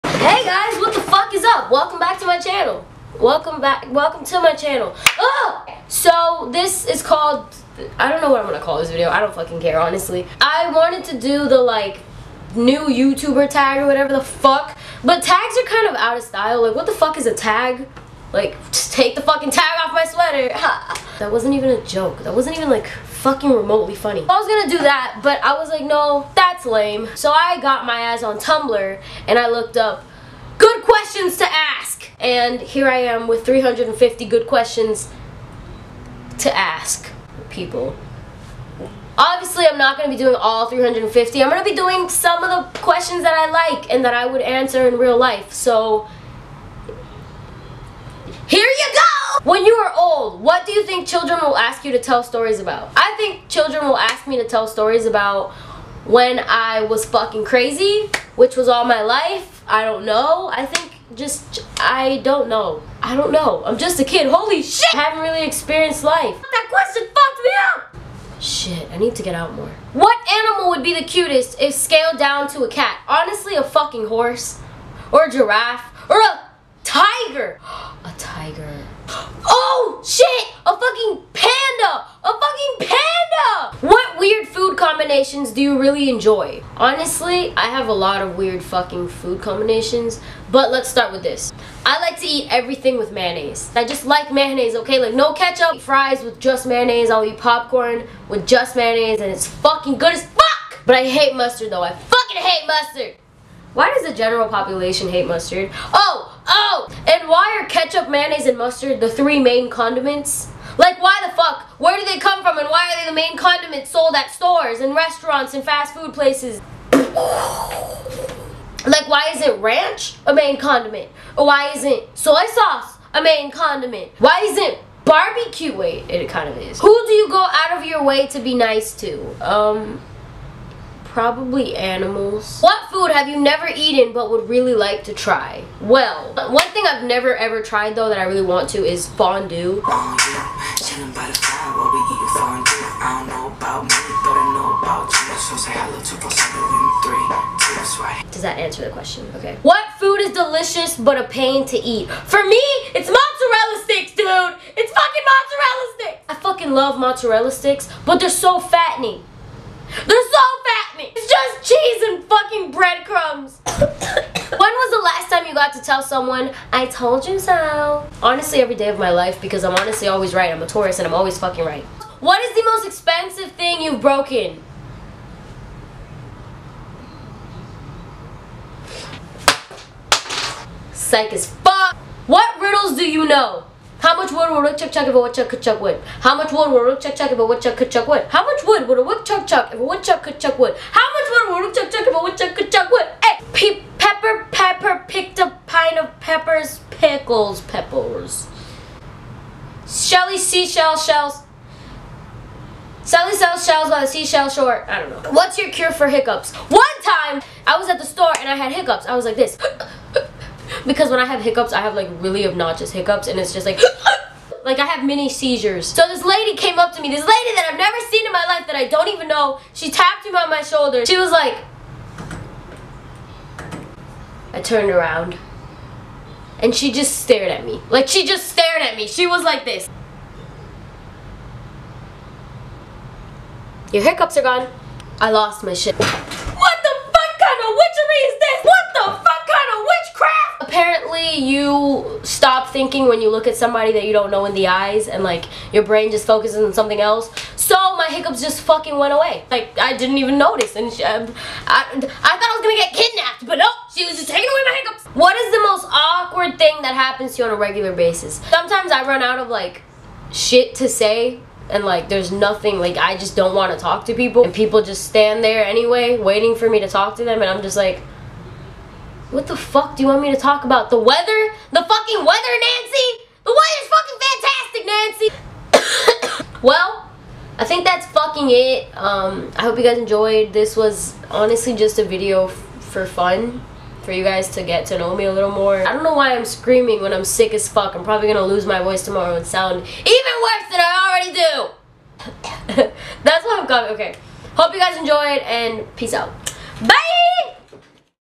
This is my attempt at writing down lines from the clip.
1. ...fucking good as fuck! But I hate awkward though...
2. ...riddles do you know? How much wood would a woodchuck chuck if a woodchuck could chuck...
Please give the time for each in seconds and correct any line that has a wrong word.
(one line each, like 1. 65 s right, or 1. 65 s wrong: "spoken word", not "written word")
1. 99 s wrong: "mustard", not "awkward"
2. 182 s right.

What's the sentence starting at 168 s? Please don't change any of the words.
Honestly, every day of my life because I'm honestly always right.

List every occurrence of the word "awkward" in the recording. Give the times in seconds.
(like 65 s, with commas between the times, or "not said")
255 s.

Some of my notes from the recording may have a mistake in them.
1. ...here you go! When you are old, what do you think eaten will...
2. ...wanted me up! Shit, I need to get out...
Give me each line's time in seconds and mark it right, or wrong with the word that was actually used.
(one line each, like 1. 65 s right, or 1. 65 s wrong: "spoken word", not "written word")
1. 48 s wrong: "children", not "eaten"
2. 67 s wrong: "fucked", not "wanted".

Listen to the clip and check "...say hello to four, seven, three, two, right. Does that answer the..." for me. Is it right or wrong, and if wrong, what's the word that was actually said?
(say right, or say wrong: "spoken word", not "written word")
right.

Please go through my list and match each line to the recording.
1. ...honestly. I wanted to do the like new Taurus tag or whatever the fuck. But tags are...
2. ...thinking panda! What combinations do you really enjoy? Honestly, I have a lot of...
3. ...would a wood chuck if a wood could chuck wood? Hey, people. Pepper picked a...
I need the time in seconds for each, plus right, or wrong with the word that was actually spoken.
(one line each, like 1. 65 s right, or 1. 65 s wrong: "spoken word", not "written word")
1. 9 s wrong: "YouTuber", not "Taurus"
2. 82 s wrong: "fucking", not "thinking"
3. 191 s right.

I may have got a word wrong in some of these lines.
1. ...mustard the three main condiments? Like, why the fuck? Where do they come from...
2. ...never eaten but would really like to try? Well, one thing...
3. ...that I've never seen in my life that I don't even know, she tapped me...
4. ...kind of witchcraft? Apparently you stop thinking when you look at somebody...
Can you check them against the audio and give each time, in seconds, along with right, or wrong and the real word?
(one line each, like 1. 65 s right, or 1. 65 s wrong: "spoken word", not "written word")
1. 108 s right
2. 133 s right
3. 217 s right
4. 239 s right.